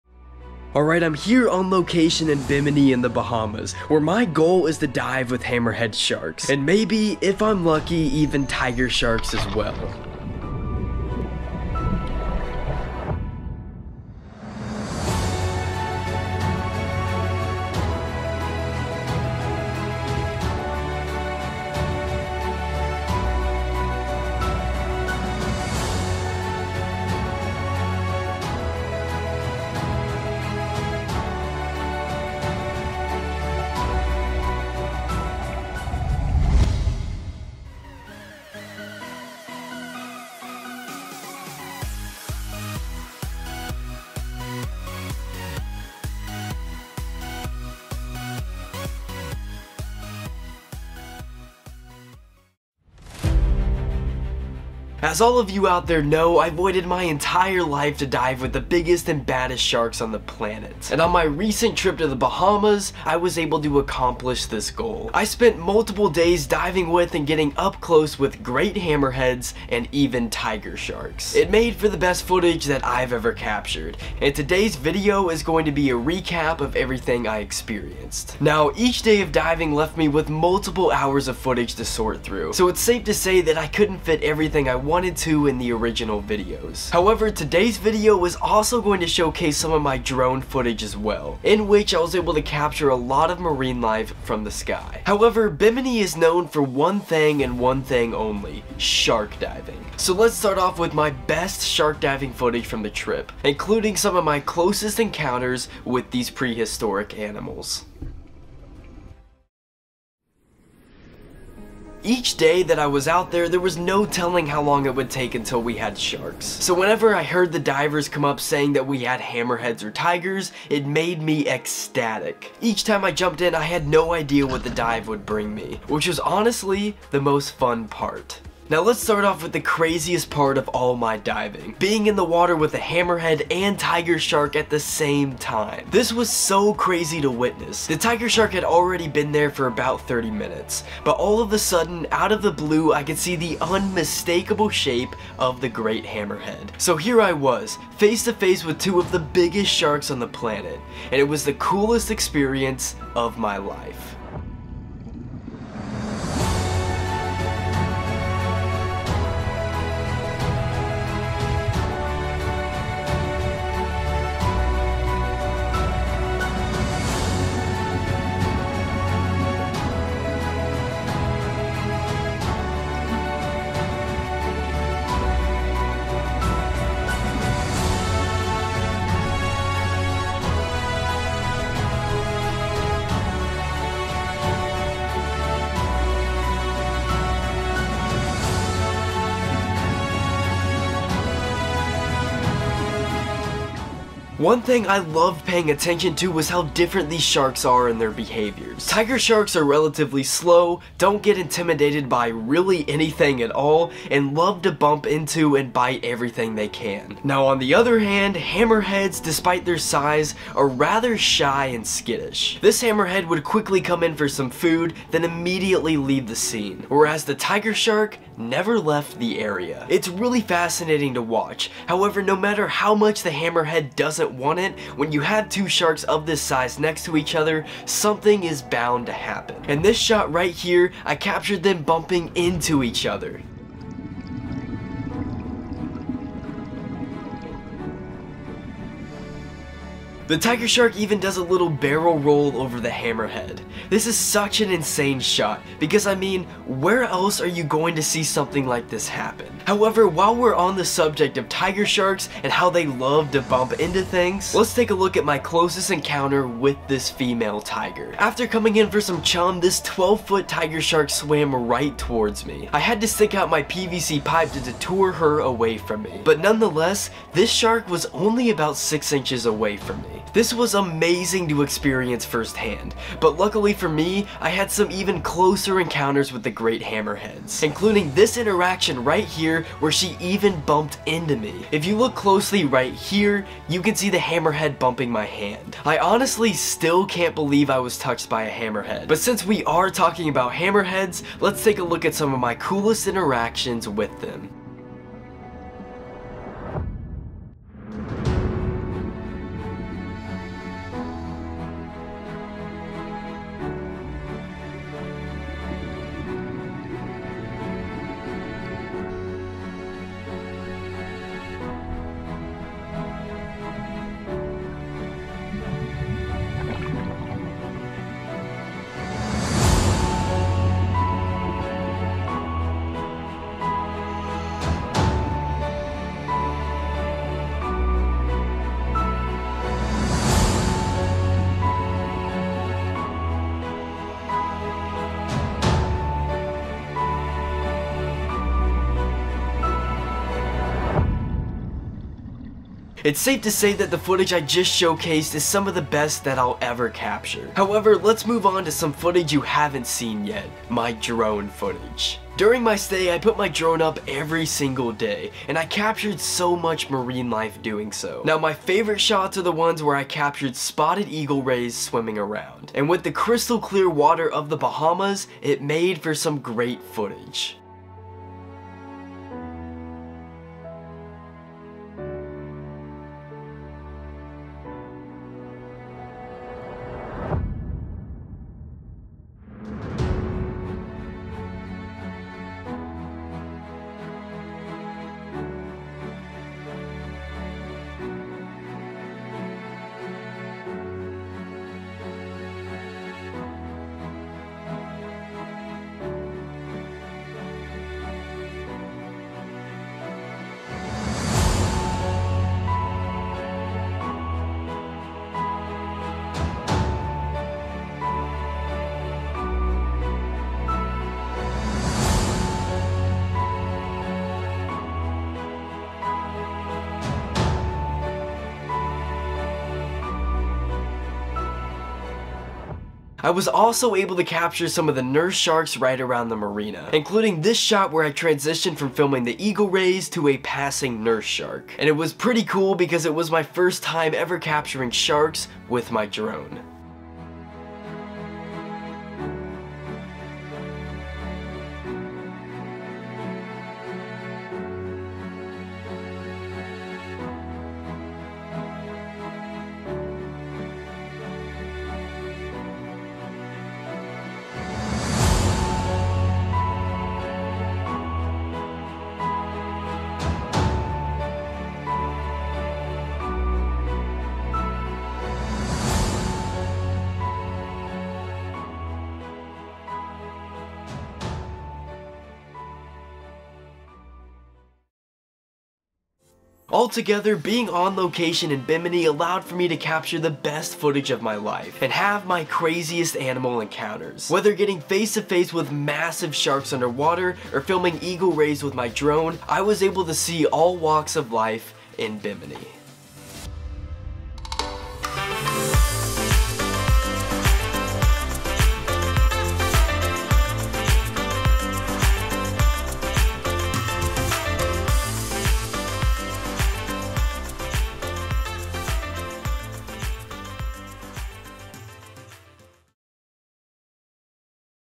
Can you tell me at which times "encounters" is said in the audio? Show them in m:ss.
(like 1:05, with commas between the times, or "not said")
1:44, 4:15, 4:35, 8:03.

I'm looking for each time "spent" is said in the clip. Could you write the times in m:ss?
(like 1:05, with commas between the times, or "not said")
1:05.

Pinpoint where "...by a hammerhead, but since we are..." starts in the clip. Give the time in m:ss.
4:48.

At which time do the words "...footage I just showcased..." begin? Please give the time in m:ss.
5:43.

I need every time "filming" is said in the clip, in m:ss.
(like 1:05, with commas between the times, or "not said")
7:08, 8:07.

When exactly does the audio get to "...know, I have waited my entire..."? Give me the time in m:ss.
0:56.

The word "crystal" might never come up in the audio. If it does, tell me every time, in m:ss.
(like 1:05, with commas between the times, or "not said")
6:03.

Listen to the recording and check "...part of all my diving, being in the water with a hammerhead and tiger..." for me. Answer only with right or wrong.
right.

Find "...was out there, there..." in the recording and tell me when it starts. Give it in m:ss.
1:52.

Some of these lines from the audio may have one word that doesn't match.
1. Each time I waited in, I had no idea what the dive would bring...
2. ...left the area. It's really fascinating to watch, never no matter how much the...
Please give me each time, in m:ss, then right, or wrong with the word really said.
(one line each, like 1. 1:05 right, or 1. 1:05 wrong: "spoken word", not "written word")
1. 2:02 wrong: "jumped", not "waited"
2. 3:38 wrong: "however", not "never".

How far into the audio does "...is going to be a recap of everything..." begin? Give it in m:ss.
1:15.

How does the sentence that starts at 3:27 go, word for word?
Now on the other hand, hammerheads, despite their size, are rather shy and skittish.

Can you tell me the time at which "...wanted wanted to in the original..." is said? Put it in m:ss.
1:24.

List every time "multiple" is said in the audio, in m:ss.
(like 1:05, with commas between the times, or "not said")
1:05, 1:20.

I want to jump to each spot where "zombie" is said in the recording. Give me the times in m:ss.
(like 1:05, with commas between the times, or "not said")
not said.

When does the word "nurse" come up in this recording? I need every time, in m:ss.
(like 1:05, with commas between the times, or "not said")
7:05, 7:11.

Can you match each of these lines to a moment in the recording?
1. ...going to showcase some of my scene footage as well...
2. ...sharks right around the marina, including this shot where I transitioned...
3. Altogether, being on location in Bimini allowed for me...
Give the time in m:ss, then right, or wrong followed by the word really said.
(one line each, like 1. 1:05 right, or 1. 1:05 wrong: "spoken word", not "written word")
1. 1:28 wrong: "drone", not "scene"
2. 7:05 right
3. 7:56 right.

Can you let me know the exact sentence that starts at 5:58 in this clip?
Now, my favorite shots are the ones where I captured spotted eagle rays swimming around.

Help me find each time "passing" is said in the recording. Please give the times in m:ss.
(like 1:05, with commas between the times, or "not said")
7:10.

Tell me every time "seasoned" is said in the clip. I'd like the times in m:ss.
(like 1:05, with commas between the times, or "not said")
not said.